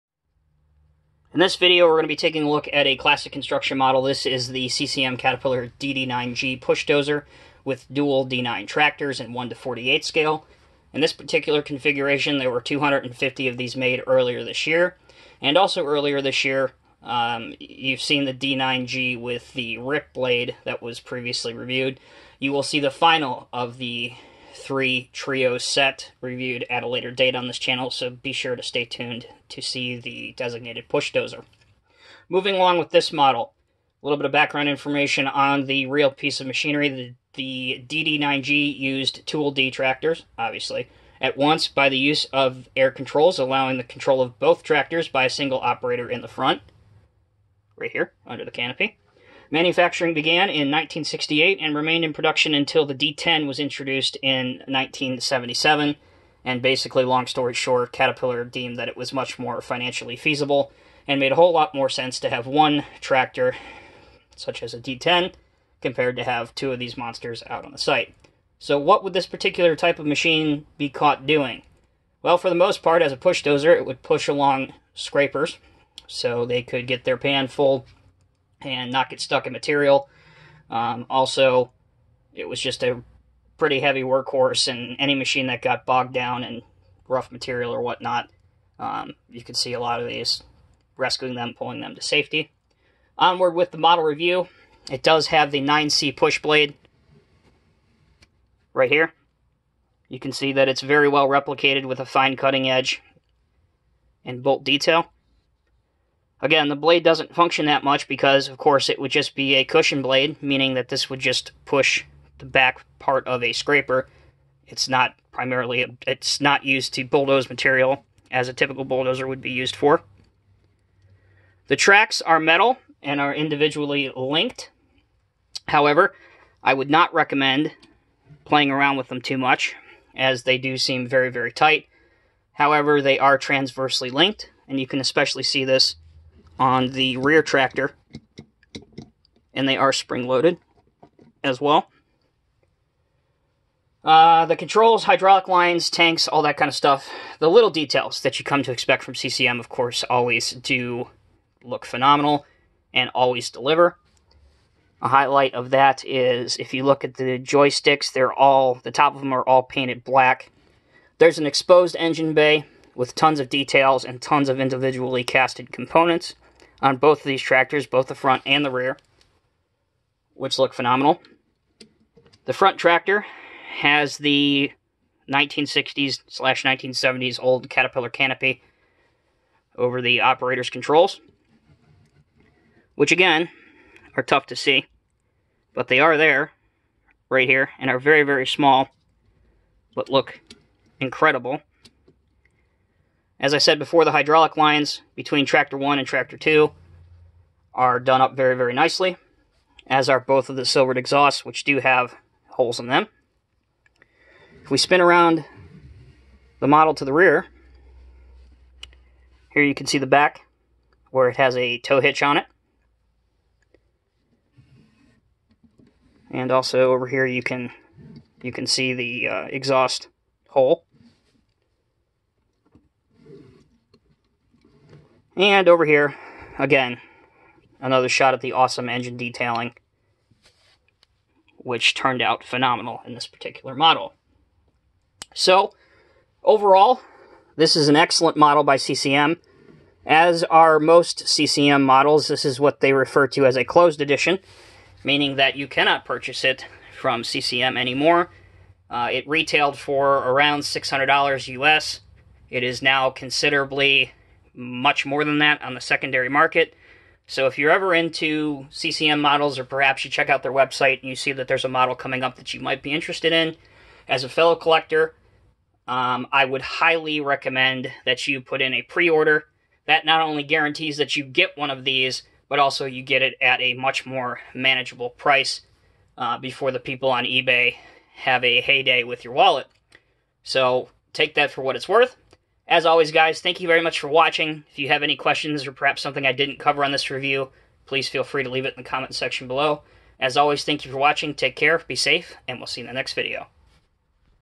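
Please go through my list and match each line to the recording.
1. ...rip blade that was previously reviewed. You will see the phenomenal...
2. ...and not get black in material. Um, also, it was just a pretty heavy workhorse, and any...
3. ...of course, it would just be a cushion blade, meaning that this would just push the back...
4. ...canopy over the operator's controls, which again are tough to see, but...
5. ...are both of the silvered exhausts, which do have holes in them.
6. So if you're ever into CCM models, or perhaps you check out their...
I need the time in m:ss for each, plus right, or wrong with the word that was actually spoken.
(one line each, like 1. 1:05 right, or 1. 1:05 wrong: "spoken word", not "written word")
1. 0:19 wrong: "final", not "phenomenal"
2. 1:18 wrong: "stuck", not "black"
3. 1:48 right
4. 2:58 right
5. 3:20 right
6. 4:17 right.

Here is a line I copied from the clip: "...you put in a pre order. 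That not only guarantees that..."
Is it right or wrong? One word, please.
right.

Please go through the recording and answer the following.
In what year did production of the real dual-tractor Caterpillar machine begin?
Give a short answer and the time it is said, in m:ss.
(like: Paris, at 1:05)
1968, at 0:50.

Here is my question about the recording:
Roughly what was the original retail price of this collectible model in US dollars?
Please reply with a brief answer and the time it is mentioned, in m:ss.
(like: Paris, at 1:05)
$600, at 4:10.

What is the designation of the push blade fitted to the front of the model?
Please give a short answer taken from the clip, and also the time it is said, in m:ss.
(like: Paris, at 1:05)
9C, at 1:35.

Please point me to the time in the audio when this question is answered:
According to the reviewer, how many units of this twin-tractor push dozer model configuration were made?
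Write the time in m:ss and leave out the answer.
0:12.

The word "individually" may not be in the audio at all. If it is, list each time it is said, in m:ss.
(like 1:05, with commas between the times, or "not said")
2:03, 2:44.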